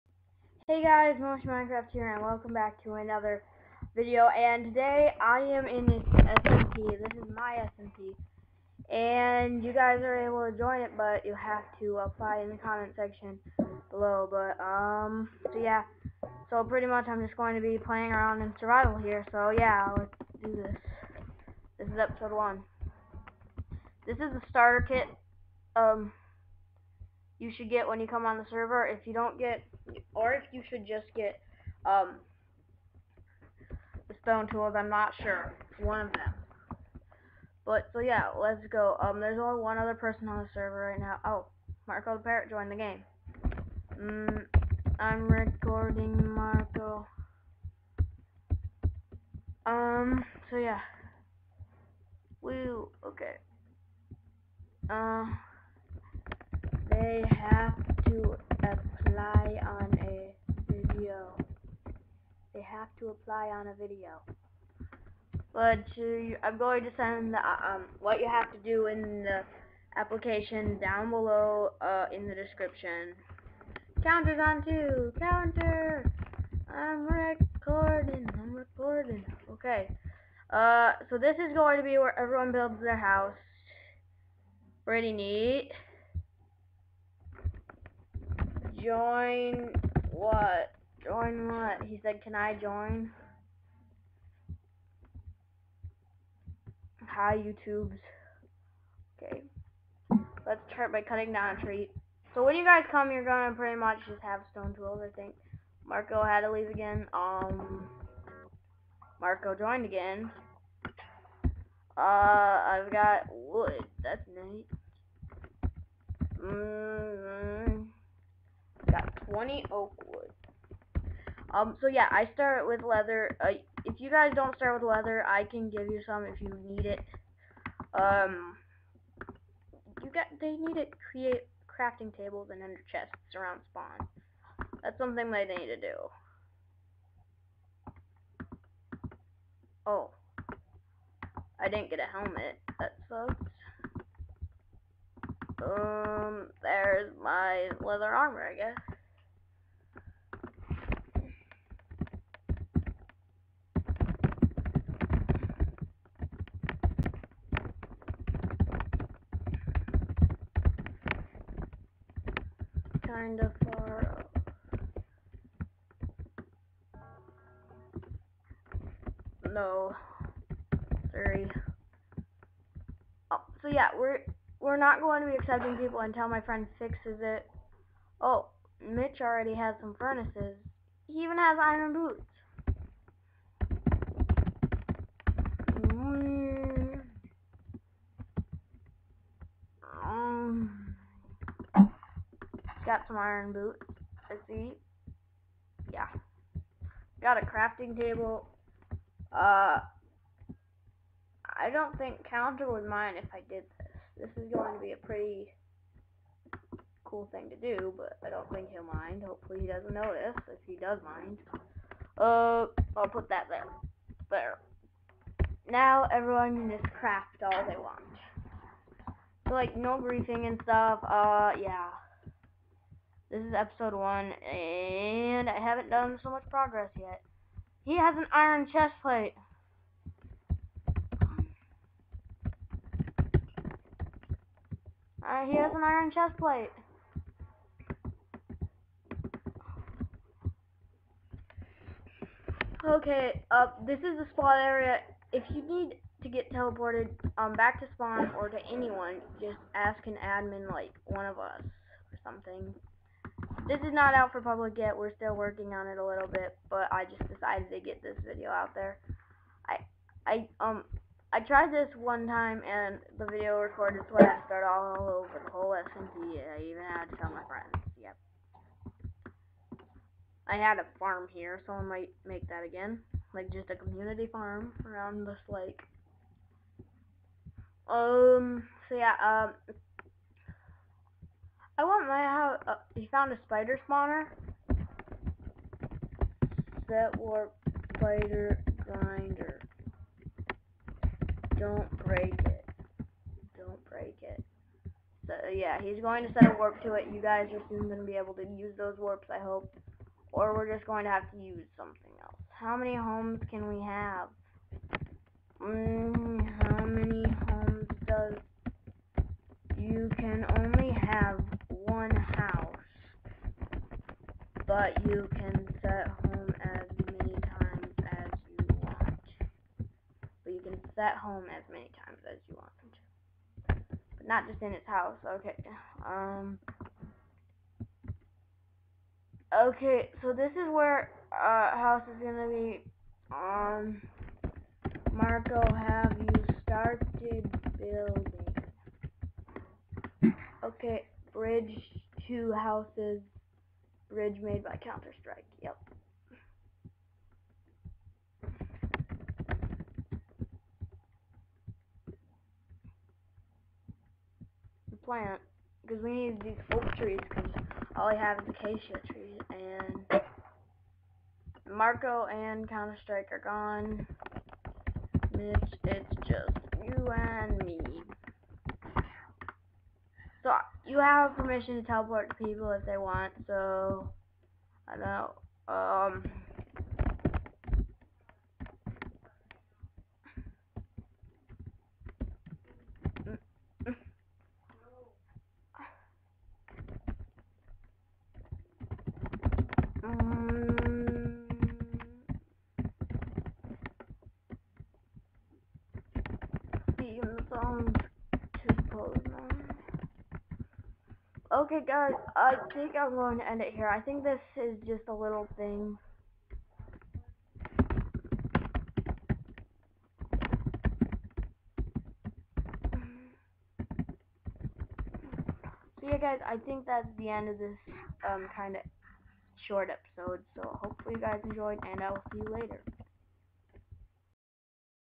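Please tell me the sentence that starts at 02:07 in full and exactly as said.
Um, you got they need to create crafting tables and under chests around spawn.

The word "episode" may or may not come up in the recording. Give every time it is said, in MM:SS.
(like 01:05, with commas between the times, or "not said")
00:22, 03:43, 06:59.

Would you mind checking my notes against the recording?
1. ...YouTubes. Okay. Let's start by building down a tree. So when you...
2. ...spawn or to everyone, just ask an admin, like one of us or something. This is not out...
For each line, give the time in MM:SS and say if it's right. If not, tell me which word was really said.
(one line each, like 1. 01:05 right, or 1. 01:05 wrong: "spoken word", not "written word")
1. 01:37 wrong: "cutting", not "building"
2. 04:07 wrong: "anyone", not "everyone".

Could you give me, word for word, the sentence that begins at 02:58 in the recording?
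Oh, Mitch already has some furnaces.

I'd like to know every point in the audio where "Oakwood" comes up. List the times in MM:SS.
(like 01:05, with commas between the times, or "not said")
01:59.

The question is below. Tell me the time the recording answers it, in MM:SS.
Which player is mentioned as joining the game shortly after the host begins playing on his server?
00:41.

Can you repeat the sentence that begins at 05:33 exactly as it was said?
Um, Marco, have you started building?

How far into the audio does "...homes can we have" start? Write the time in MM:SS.
05:02.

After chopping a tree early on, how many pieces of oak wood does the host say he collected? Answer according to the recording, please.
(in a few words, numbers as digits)
20.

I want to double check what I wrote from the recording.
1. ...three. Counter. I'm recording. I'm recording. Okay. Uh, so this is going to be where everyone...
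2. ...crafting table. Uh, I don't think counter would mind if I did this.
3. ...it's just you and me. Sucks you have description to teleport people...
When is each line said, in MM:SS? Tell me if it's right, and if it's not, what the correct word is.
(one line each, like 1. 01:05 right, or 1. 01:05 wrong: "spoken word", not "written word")
1. 01:14 wrong: "two", not "three"
2. 03:17 right
3. 06:05 wrong: "permission", not "description".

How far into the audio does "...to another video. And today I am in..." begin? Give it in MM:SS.
00:02.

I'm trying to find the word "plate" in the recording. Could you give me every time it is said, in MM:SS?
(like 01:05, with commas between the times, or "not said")
03:49, 03:56.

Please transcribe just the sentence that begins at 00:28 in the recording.
If you don't get, or if you should just get um, the stone tools, I'm not sure.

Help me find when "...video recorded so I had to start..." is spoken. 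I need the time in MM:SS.
04:23.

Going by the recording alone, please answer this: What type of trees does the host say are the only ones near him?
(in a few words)
acacia.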